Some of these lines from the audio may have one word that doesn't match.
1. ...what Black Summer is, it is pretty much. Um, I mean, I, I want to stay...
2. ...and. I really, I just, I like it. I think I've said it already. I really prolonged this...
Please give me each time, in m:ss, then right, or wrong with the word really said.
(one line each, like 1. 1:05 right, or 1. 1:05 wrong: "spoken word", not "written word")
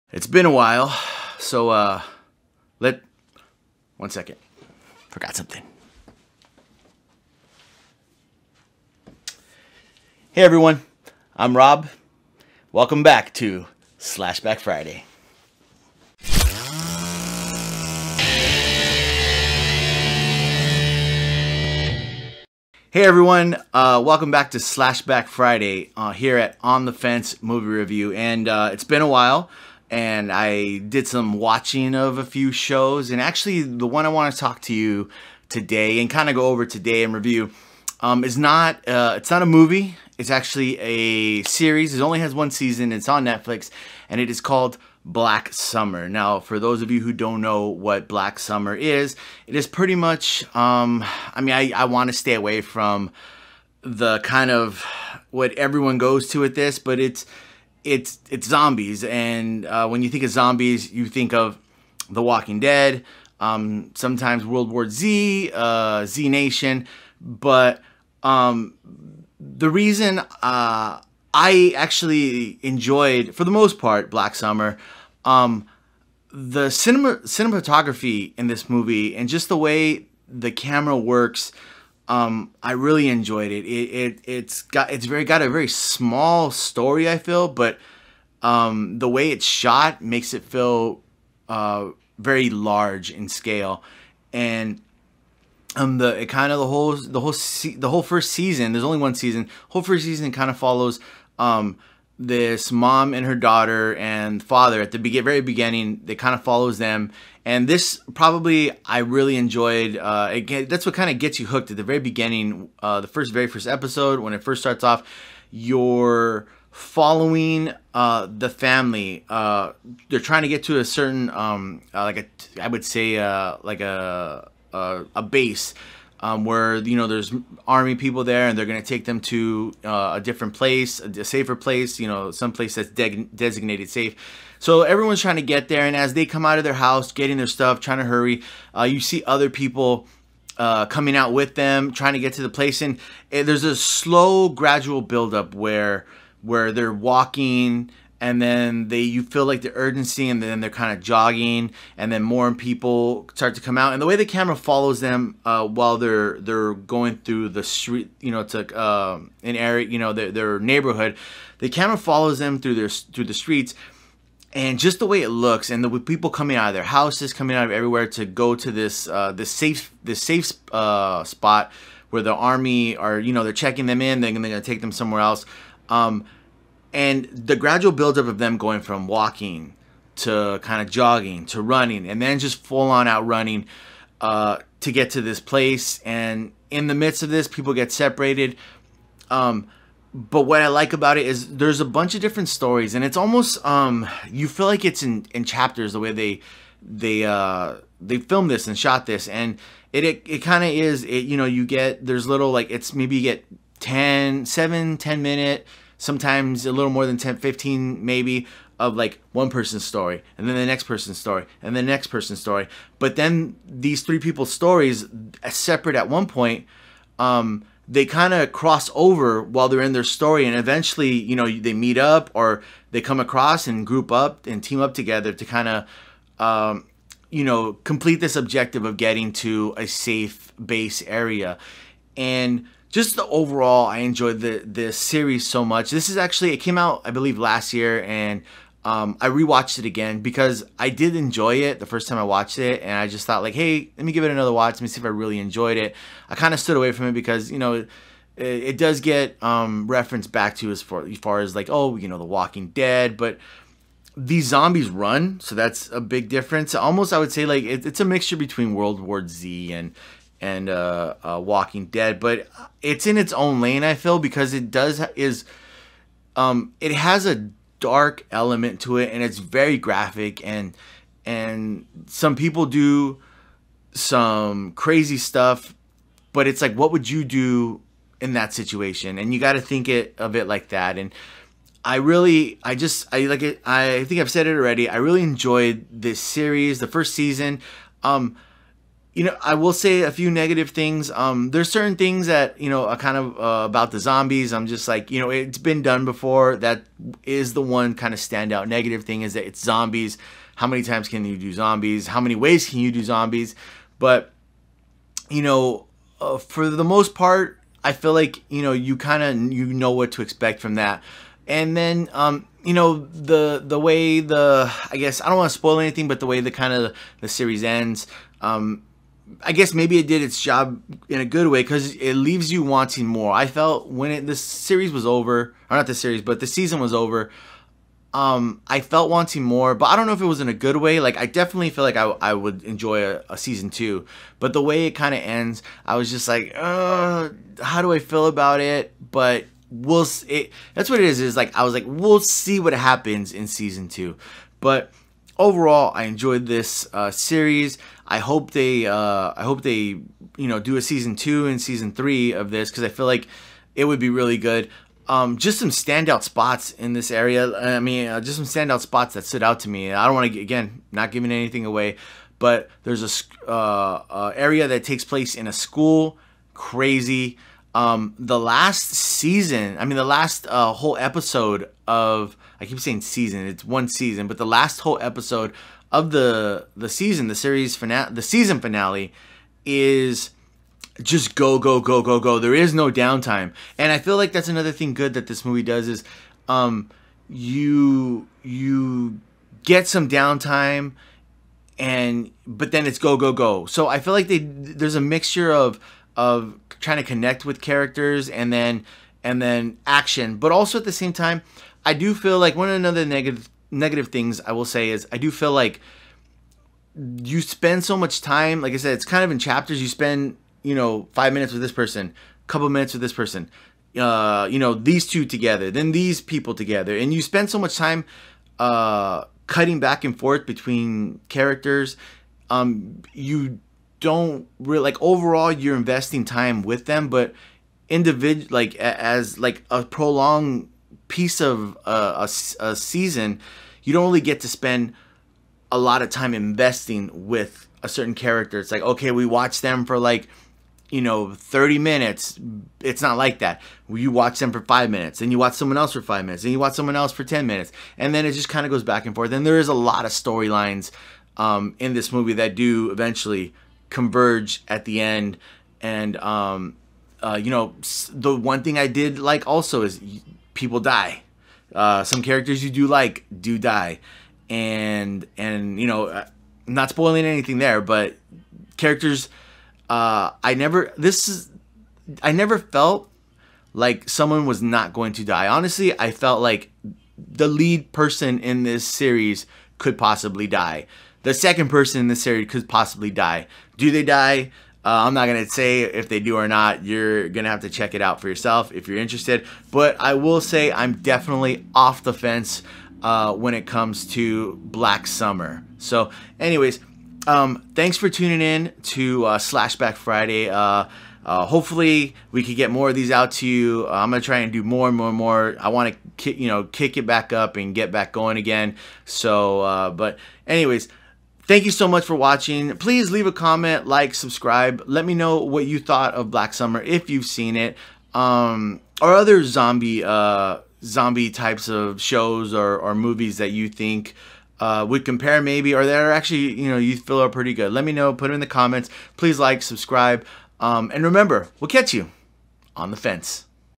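1. 0:47 right
2. 4:40 wrong: "enjoyed", not "prolonged".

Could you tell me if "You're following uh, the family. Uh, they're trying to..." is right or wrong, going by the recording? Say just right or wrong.
right.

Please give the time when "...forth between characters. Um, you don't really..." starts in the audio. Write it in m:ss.
7:00.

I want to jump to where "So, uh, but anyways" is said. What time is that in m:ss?
8:29.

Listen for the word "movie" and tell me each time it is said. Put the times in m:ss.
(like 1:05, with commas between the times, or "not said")
0:27, 0:39, 1:18, 6:25, 7:32, 8:42.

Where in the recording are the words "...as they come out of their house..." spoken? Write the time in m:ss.
2:15.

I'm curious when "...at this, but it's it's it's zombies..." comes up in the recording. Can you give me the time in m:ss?
0:56.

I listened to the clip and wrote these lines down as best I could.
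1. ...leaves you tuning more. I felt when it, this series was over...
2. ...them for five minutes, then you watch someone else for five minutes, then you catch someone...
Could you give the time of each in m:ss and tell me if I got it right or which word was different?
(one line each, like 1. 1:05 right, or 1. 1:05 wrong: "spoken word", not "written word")
1. 5:22 wrong: "wanting", not "tuning"
2. 7:24 wrong: "watch", not "catch".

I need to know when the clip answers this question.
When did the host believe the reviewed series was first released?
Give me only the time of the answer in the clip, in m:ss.
3:57.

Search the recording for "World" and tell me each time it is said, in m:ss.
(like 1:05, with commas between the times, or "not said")
1:04, 4:18.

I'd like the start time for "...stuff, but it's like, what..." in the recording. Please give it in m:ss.
4:35.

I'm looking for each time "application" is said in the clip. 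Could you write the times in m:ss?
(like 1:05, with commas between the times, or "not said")
not said.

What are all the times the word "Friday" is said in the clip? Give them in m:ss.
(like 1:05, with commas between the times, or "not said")
0:14, 0:25, 8:19.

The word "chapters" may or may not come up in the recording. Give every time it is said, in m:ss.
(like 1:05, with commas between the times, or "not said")
3:15, 6:49.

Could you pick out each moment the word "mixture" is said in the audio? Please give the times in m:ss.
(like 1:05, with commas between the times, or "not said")
4:18, 6:35.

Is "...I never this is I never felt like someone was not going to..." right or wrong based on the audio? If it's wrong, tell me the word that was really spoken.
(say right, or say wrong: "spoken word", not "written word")
right.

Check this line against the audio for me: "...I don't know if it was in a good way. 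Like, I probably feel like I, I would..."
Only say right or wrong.
wrong.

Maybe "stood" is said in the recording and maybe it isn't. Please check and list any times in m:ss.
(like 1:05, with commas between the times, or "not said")
4:06, 5:59.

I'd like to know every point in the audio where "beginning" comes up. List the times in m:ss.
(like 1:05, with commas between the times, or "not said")
1:45, 1:51.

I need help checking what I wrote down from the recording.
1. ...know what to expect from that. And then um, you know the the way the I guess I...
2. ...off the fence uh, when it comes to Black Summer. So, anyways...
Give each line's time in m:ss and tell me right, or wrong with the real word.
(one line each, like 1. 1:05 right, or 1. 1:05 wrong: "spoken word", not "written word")
1. 5:09 right
2. 8:11 right.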